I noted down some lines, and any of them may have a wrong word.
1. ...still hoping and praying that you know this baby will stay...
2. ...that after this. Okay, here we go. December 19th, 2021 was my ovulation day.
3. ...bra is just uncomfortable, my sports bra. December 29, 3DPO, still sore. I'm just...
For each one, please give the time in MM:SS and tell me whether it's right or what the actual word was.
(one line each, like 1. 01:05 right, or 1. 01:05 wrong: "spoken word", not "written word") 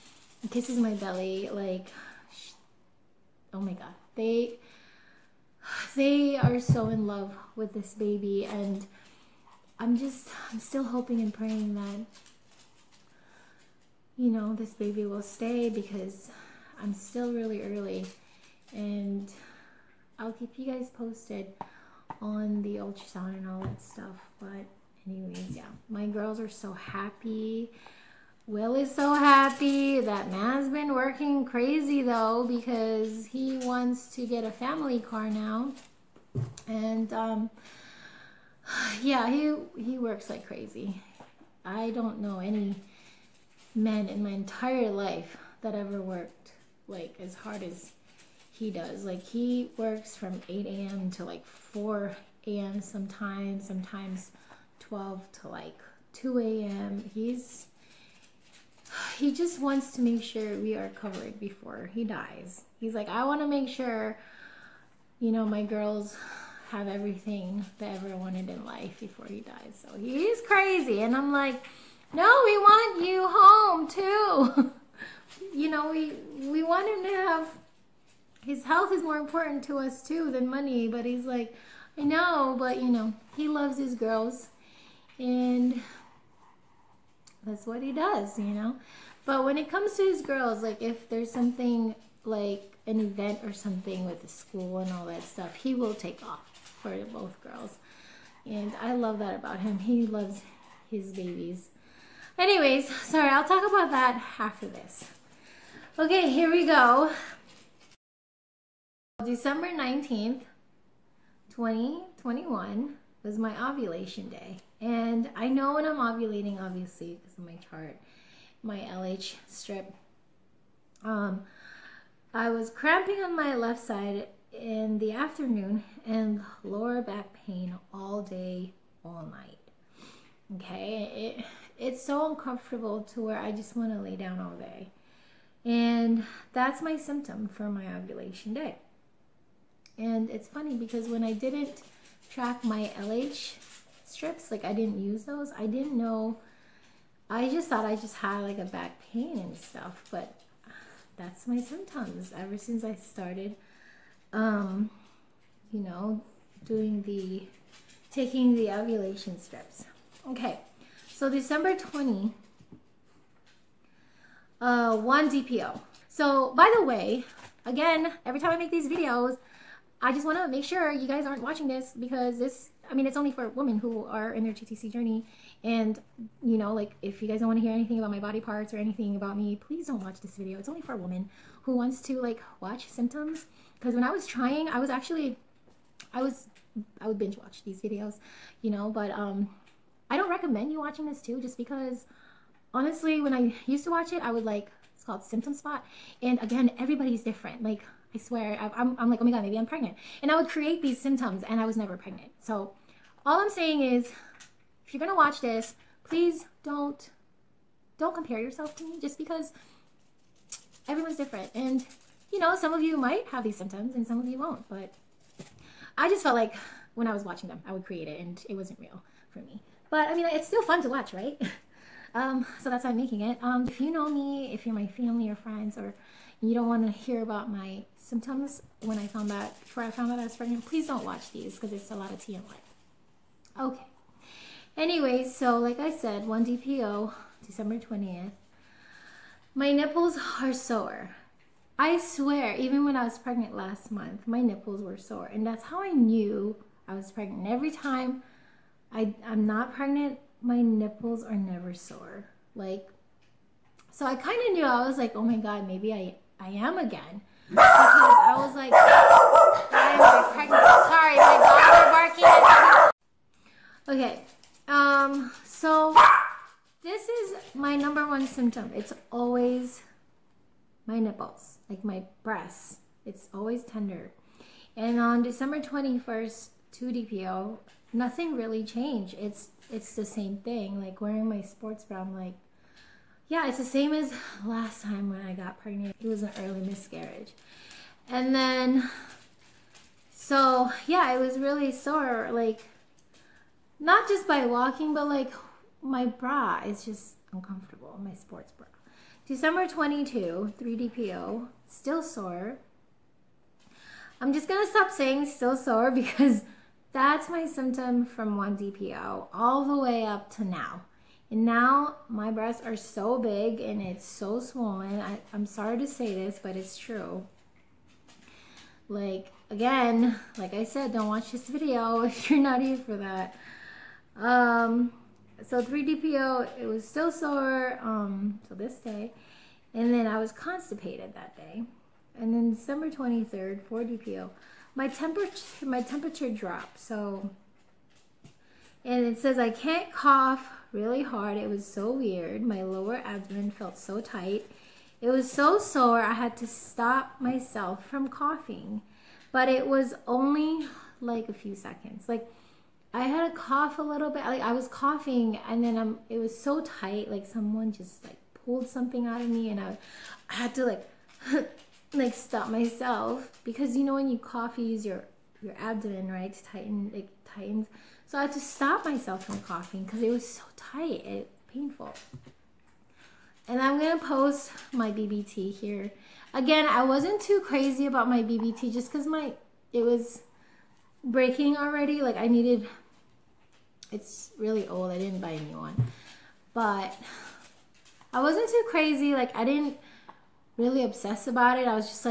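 1. 00:10 right
2. 01:43 right
3. 04:56 wrong: "22", not "29".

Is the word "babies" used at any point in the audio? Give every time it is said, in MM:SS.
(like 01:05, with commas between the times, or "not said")
01:41.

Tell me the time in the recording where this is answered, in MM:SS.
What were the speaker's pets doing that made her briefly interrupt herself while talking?
04:24.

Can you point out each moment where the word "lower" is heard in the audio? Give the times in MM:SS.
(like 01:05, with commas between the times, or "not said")
02:06, 05:42.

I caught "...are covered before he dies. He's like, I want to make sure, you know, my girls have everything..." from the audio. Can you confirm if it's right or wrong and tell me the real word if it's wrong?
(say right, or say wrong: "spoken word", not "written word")
right.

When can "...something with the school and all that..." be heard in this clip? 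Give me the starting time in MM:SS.
01:33.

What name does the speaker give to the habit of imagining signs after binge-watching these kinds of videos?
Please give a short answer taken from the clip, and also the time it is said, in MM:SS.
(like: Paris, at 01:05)
Symptom Spot, at 03:15.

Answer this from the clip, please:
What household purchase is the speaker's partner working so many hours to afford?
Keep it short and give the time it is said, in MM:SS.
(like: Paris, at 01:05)
A family car, at 00:34.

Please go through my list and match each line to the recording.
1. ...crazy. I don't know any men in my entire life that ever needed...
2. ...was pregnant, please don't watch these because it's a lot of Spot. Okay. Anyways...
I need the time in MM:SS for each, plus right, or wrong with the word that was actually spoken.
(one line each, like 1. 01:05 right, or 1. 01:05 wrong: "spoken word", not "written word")
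1. 00:40 wrong: "worked", not "needed"
2. 03:50 wrong: "TMI", not "Spot".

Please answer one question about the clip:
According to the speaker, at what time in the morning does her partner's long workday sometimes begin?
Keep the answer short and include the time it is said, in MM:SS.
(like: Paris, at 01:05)
8 a.m., at 00:50.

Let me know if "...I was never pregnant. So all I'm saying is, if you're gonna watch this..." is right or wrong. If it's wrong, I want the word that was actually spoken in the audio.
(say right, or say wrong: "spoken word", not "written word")
right.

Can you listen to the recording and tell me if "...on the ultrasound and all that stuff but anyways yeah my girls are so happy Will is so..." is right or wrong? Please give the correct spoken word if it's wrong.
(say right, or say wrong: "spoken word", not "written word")
right.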